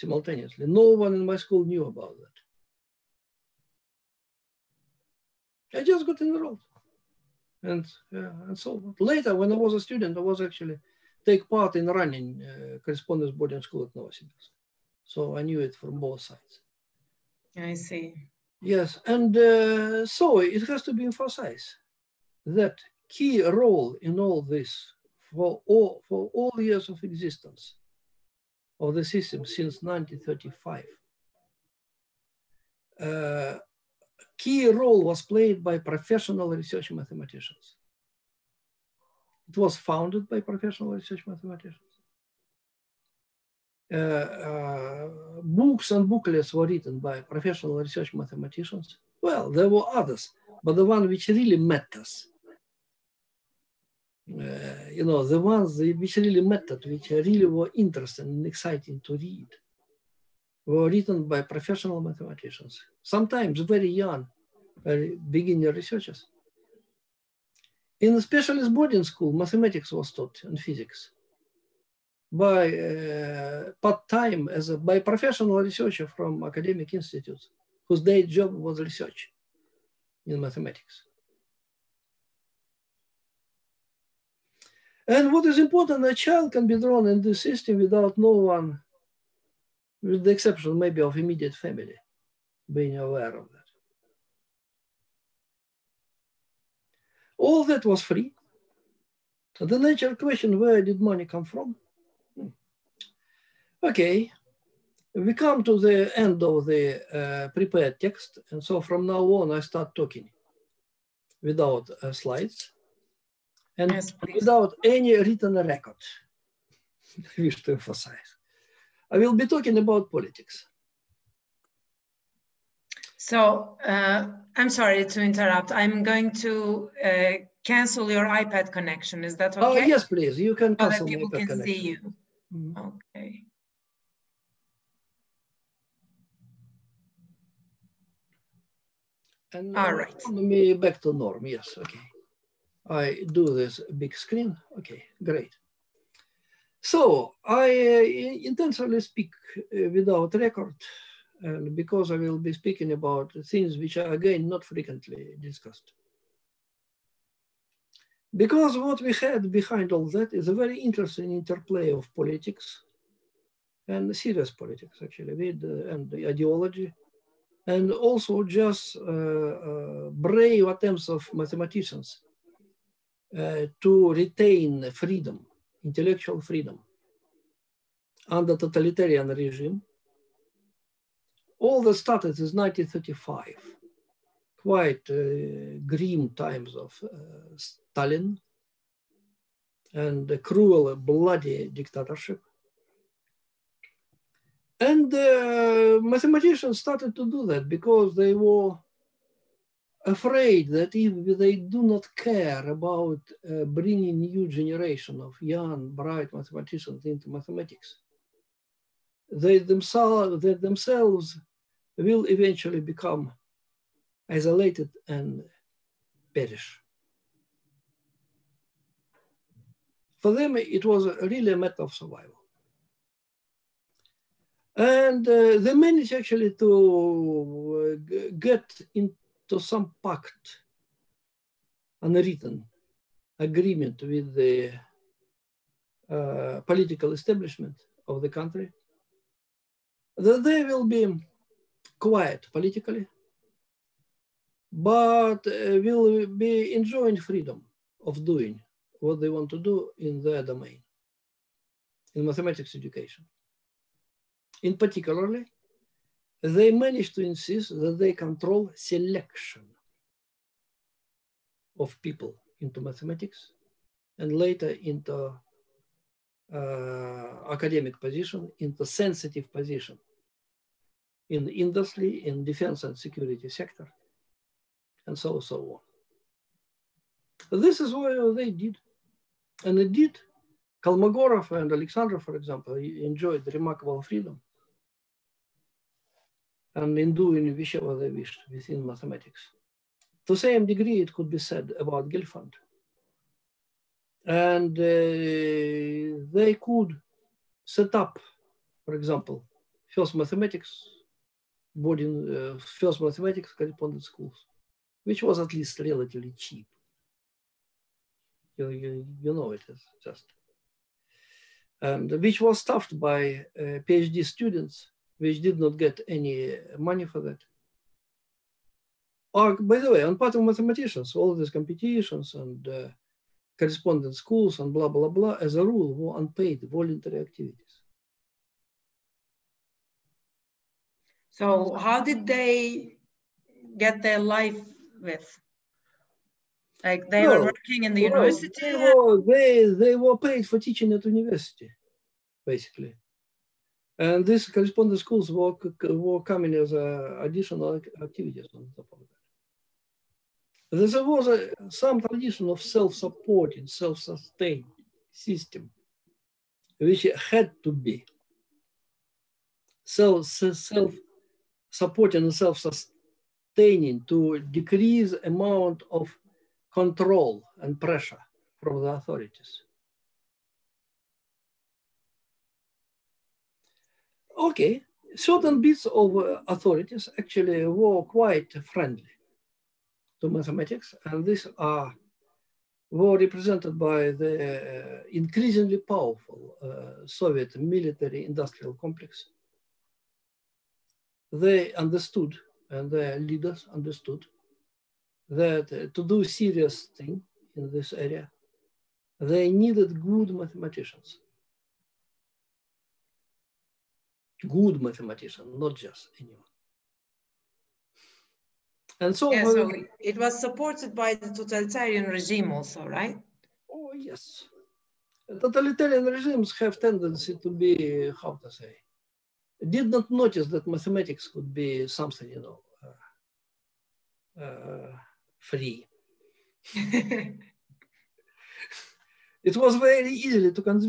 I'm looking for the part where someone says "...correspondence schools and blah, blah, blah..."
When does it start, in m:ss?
5:23.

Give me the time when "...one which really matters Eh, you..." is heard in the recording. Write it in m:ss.
0:50.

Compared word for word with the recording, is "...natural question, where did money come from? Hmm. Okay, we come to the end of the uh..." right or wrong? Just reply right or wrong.
right.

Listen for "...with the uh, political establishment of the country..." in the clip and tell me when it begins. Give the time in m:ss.
3:54.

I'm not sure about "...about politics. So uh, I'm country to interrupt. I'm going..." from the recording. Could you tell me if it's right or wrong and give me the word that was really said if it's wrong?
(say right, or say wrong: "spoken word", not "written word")
wrong: "sorry", not "country".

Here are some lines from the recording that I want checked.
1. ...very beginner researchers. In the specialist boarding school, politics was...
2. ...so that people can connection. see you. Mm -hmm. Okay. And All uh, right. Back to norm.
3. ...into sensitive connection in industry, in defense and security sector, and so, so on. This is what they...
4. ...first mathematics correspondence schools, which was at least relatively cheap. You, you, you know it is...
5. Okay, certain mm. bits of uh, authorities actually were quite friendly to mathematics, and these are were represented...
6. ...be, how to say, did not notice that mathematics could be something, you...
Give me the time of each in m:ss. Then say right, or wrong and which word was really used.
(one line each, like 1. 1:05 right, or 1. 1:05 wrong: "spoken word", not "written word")
1. 1:04 wrong: "mathematics", not "politics"
2. 2:10 right
3. 4:28 wrong: "position", not "connection"
4. 5:02 right
5. 6:14 right
6. 6:57 right.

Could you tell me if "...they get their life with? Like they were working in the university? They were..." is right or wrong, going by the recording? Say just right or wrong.
right.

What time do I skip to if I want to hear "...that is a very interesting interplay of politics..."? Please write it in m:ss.
2:40.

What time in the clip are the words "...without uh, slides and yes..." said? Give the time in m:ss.
1:51.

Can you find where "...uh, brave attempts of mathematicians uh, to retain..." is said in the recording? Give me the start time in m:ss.
2:49.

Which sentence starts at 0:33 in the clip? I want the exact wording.
Uh, key role was played by professional research mathematicians.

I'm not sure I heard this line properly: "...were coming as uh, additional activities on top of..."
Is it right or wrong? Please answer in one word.
right.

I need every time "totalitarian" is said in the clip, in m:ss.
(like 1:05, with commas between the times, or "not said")
2:58, 6:51, 6:55.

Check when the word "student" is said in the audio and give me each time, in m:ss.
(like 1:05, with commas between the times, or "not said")
0:09, 5:14.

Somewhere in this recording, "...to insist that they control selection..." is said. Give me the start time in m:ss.
4:17.